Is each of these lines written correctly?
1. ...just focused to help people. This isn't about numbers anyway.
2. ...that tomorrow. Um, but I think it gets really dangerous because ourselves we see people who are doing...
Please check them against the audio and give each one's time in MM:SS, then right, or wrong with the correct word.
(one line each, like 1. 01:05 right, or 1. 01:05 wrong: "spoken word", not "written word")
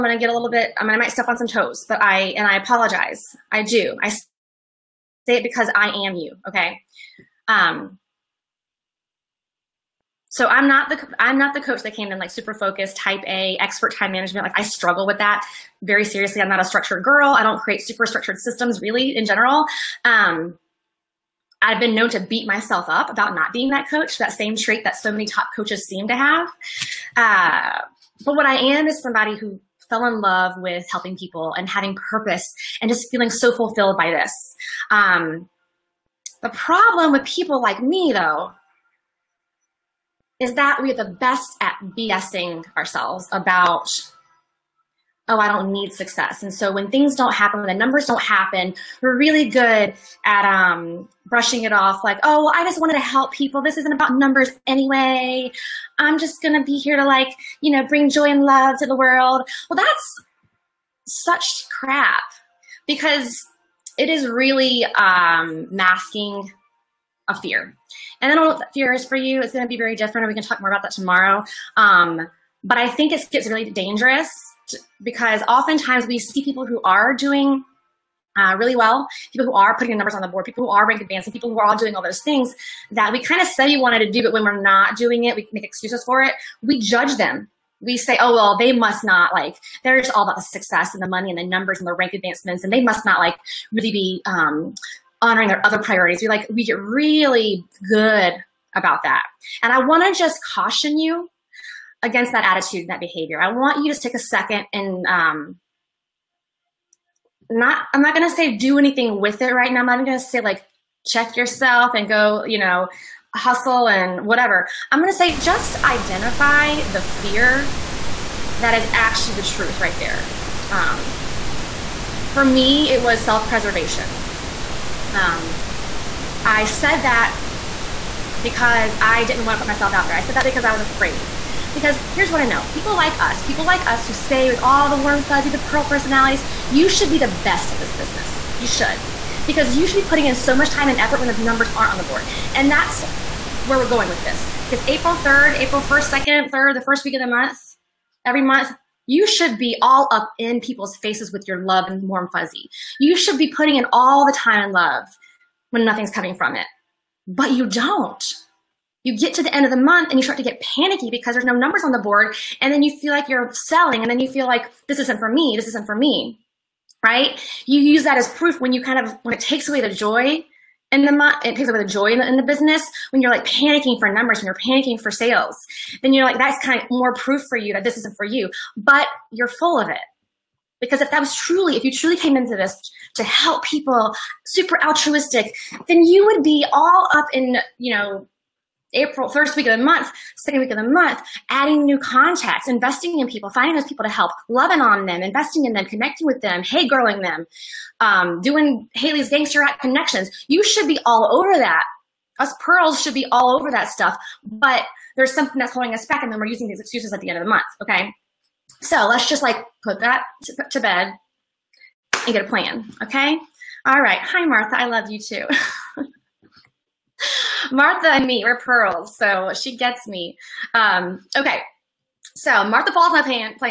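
1. 00:52 wrong: "wanted", not "focused"
2. 01:10 wrong: "oftentimes", not "ourselves".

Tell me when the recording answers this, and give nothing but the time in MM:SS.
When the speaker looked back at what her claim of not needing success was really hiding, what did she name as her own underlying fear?
02:03.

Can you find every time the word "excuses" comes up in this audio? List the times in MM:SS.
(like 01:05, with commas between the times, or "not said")
01:25, 03:26.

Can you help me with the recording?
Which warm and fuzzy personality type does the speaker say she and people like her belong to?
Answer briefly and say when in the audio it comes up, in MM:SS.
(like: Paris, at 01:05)
Pearl, at 02:15.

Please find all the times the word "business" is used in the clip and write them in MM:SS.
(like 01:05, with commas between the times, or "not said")
02:17, 02:52.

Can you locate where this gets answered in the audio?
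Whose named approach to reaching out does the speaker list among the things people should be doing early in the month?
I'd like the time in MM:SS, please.
03:18.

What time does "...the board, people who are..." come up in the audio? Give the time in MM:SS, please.
01:20.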